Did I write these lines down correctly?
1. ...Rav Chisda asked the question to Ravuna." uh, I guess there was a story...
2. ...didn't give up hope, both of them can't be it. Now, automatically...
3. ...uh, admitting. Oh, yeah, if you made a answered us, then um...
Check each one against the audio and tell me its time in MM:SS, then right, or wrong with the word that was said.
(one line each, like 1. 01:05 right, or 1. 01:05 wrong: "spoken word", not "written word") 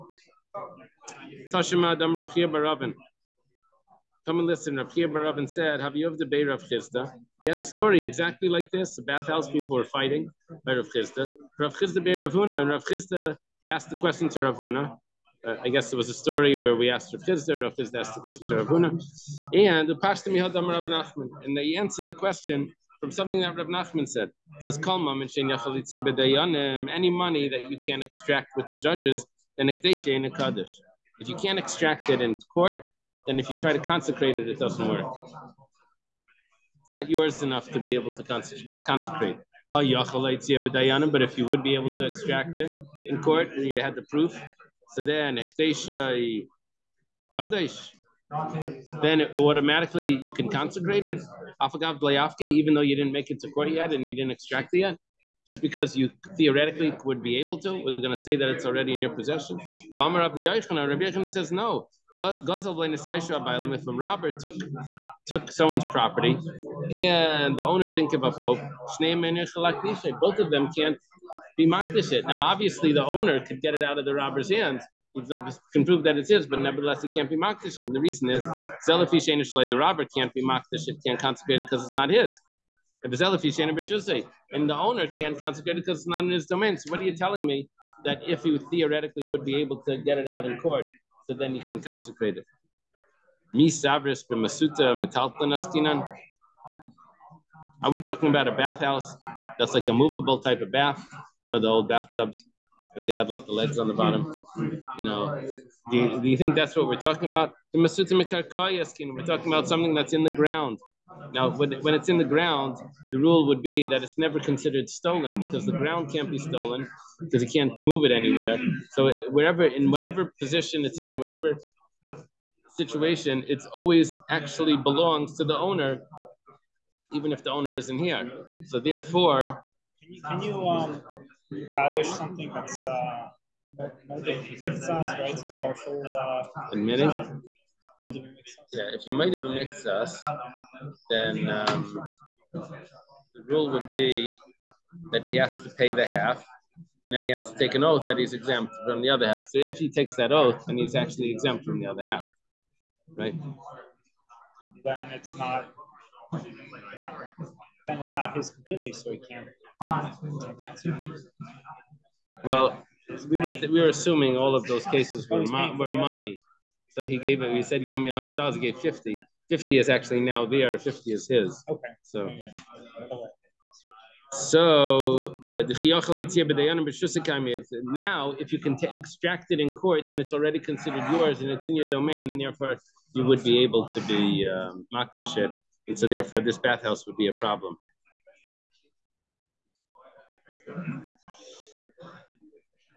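1. 00:12 right
2. 01:07 wrong: "obviously", not "automatically"
3. 02:16 wrong: "mixed", not "answered".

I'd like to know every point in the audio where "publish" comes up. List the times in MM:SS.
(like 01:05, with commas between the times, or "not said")
02:11.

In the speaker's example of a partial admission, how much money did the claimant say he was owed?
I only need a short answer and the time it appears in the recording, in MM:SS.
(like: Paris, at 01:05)
100 dollars, at 02:48.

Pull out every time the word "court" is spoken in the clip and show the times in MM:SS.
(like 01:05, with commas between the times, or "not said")
00:32, 00:43, 00:53, 01:30, 02:59.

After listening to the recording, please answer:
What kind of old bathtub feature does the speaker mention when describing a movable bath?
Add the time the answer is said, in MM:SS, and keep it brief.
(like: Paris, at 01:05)
legs on the bottom, at 01:43.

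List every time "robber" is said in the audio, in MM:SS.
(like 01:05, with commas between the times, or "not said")
01:14, 01:19.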